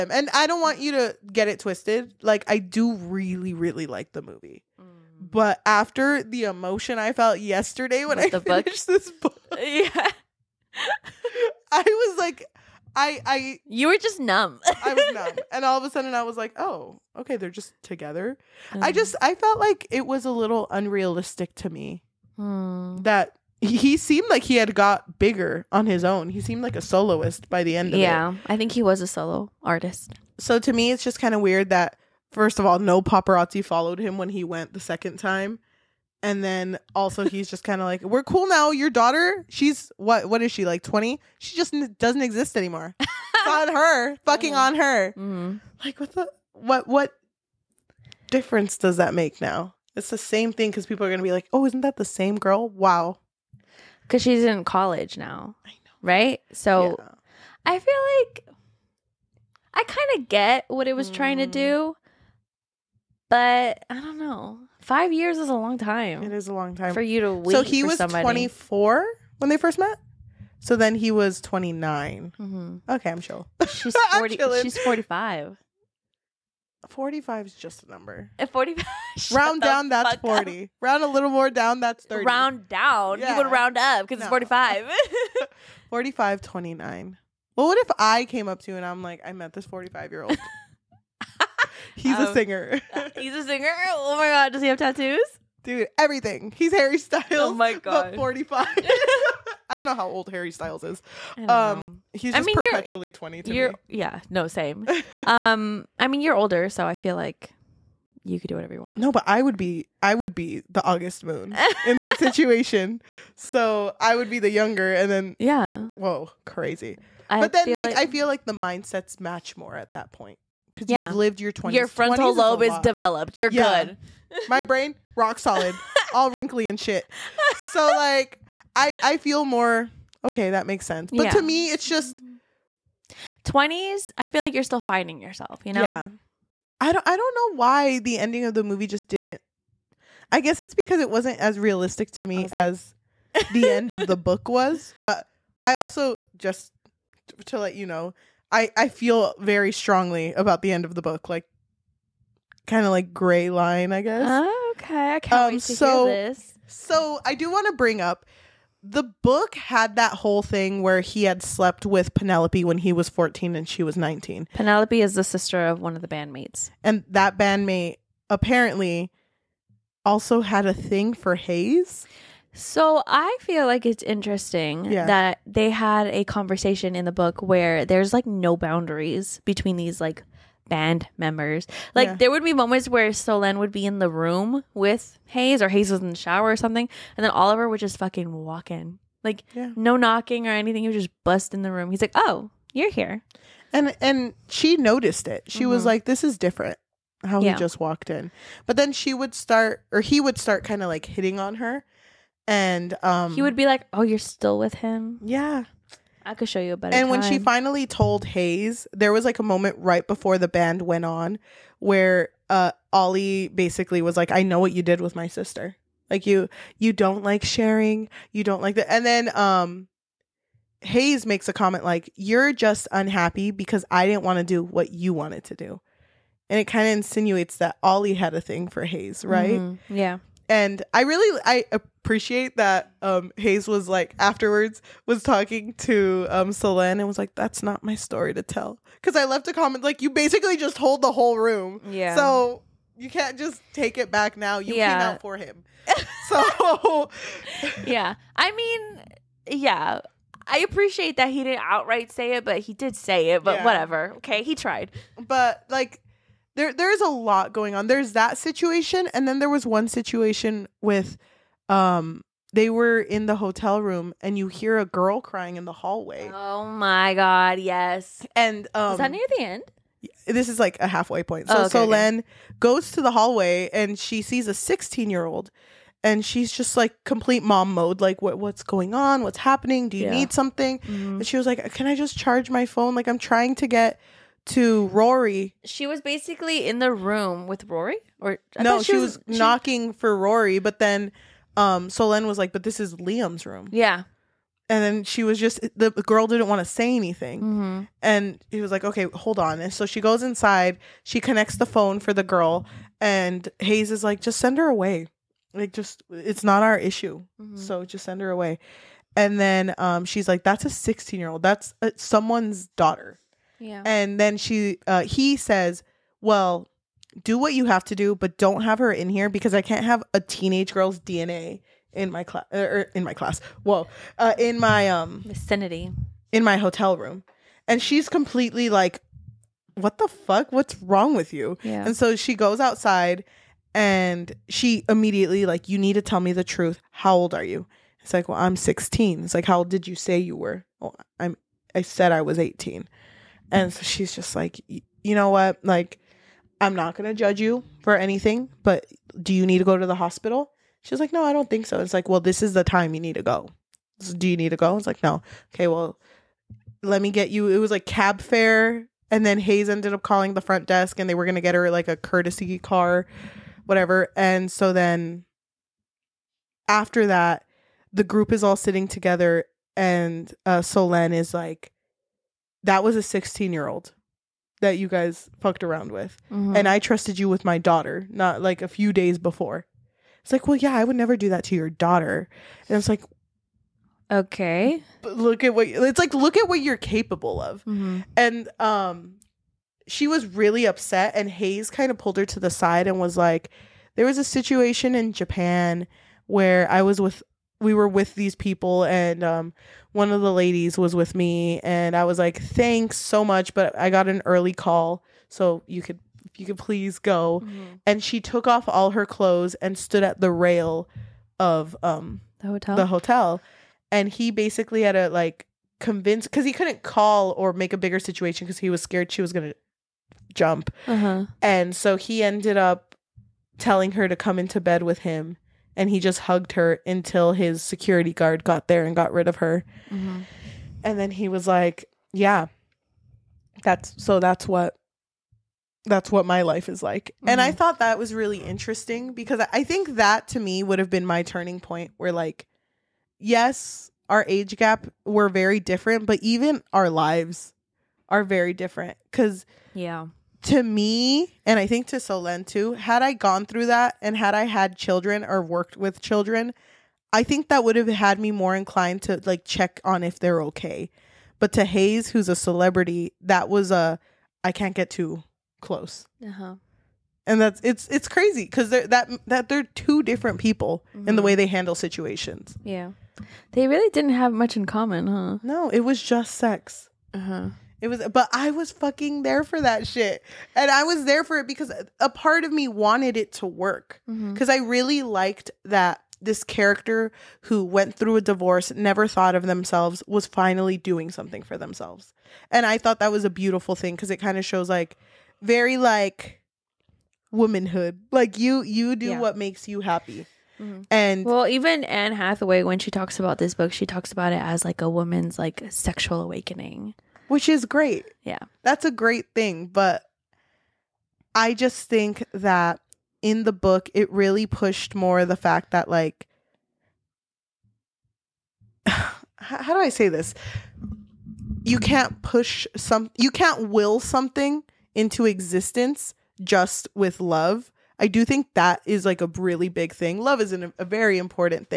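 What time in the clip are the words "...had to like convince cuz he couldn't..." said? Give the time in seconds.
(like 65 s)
414 s.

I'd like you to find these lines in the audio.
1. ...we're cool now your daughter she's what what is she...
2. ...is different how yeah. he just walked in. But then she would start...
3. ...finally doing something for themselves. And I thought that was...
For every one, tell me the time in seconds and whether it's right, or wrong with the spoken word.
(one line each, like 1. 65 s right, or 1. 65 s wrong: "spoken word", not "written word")
1. 38 s right
2. 196 s right
3. 490 s right.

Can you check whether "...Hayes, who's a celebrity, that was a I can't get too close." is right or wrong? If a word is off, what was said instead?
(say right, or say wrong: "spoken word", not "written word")
right.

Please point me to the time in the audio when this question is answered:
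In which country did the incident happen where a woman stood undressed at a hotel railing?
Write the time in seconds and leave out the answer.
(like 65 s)
395 s.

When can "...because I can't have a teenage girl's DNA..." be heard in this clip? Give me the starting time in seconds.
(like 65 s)
319 s.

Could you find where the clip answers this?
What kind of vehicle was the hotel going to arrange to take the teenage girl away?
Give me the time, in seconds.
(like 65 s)
361 s.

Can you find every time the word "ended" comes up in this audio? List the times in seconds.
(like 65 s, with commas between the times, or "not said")
359 s, 422 s.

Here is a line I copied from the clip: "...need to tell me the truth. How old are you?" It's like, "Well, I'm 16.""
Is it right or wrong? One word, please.
right.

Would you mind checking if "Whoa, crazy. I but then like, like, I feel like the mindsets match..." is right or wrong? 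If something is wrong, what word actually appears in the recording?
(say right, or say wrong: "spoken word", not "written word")
right.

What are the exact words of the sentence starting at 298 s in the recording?
and he was like, "Okay, hold on." And so she goes inside.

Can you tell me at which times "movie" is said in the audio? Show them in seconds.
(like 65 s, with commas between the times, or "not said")
4 s, 138 s.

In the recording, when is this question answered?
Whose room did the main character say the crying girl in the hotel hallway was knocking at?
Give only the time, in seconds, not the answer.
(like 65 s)
292 s.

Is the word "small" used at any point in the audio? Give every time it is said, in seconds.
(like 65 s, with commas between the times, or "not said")
not said.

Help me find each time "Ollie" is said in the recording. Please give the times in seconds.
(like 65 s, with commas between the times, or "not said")
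212 s, 227 s.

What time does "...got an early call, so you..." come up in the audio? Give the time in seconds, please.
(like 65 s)
403 s.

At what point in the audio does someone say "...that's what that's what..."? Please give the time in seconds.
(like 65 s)
434 s.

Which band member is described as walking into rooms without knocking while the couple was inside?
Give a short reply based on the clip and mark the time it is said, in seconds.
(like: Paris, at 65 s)
Oliver, at 187 s.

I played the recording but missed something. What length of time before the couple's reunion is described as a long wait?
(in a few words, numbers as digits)
5 years.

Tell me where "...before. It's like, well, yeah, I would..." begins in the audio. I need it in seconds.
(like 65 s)
379 s.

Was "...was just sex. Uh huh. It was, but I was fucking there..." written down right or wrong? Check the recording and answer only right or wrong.
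right.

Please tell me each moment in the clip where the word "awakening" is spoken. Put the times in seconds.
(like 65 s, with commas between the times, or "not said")
506 s.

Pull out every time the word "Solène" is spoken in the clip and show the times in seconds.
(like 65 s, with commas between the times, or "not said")
183 s, 291 s, 451 s.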